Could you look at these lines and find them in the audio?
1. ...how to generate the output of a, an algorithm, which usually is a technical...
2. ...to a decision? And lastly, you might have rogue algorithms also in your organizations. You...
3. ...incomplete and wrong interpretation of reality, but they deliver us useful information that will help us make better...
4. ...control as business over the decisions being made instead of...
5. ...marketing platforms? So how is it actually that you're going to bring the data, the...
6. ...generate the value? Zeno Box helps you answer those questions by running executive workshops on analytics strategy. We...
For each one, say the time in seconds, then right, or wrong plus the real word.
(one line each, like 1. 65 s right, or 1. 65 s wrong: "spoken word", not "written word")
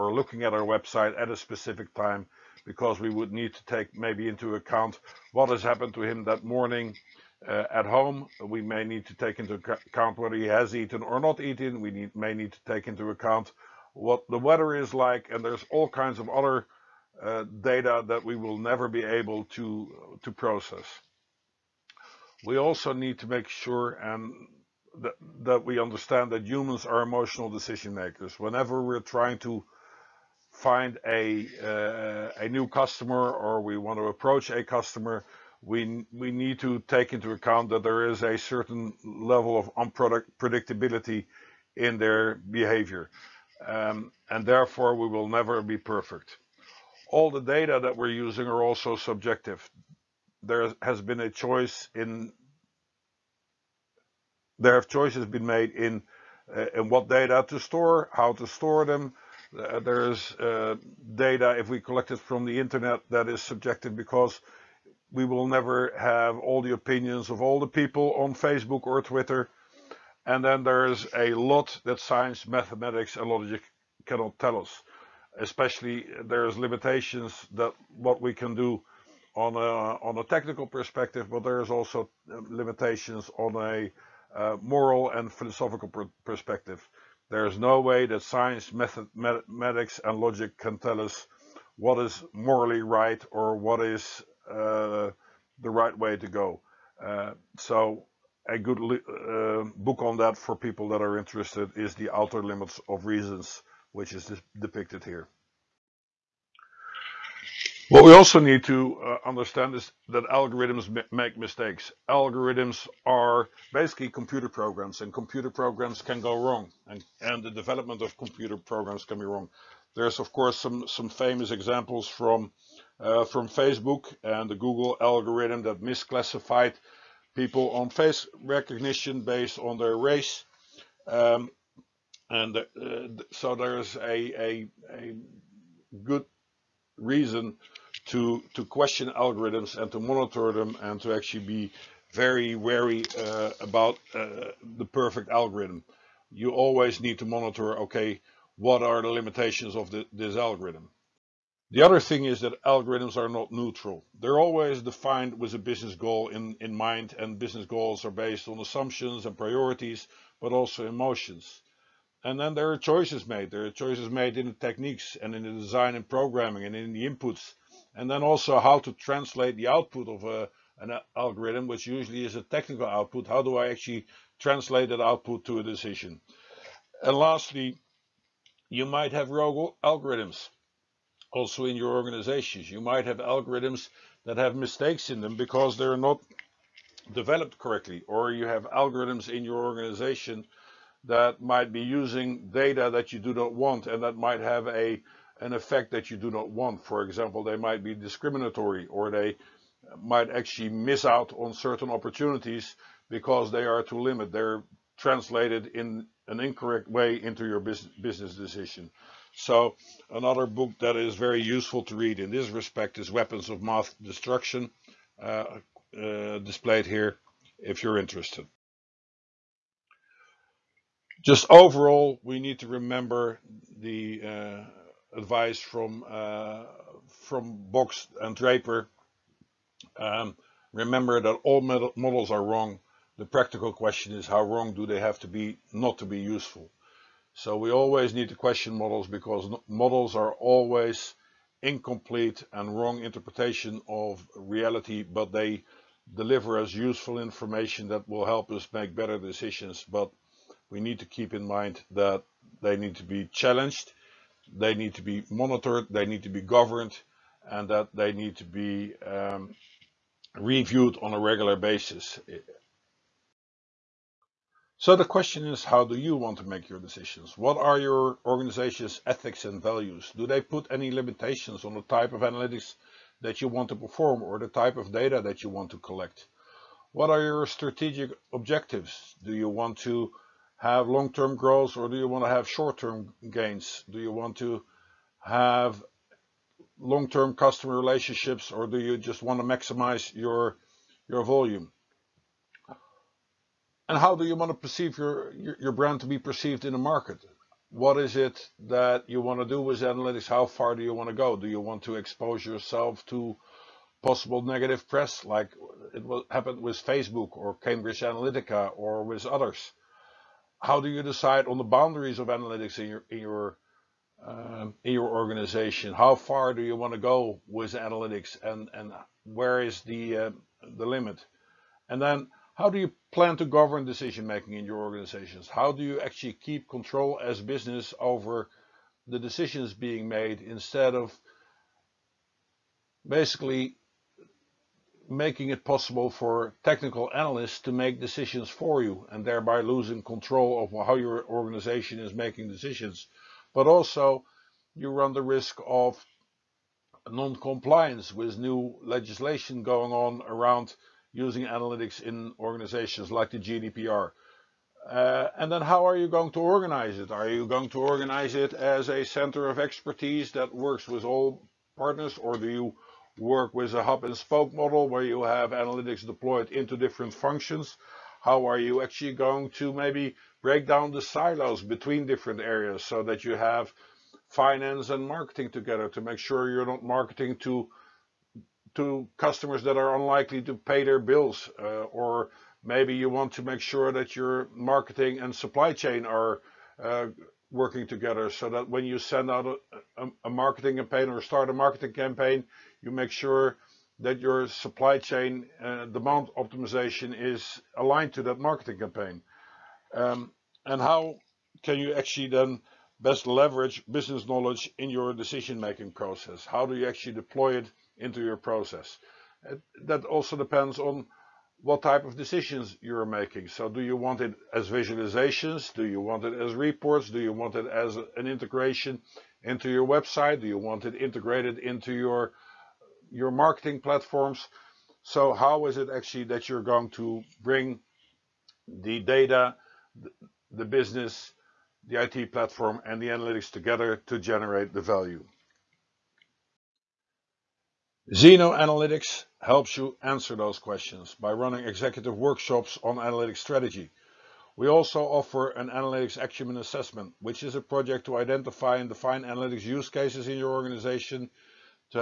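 1. 168 s wrong: "translate", not "generate"
2. 175 s right
3. 241 s right
4. 326 s right
5. 423 s right
6. 434 s wrong: "Analytics", not "Box".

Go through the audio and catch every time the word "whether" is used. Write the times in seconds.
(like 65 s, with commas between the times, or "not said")
10 s.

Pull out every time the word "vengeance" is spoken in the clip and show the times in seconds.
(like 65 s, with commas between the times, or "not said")
not said.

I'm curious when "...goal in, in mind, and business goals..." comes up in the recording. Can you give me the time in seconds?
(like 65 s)
155 s.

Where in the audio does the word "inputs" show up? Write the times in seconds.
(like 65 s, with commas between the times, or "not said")
167 s.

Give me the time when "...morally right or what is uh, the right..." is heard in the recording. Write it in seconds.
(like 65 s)
92 s.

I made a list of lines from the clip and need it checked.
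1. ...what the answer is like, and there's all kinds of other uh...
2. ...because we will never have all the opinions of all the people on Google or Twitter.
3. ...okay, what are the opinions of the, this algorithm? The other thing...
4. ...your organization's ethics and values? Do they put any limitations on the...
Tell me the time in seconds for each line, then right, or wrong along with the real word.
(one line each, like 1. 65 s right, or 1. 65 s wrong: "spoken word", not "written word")
1. 13 s wrong: "weather", not "answer"
2. 63 s wrong: "Facebook", not "Google"
3. 147 s wrong: "limitations", not "opinions"
4. 267 s right.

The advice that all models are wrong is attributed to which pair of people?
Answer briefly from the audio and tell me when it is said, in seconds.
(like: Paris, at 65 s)
Box and Draper, at 227 s.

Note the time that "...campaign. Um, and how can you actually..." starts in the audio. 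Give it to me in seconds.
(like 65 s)
398 s.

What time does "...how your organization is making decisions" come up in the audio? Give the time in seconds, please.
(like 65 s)
340 s.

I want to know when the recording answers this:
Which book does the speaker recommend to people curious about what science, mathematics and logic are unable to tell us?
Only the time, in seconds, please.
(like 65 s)
101 s.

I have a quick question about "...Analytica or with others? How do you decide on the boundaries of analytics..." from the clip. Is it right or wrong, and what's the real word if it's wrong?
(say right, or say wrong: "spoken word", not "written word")
right.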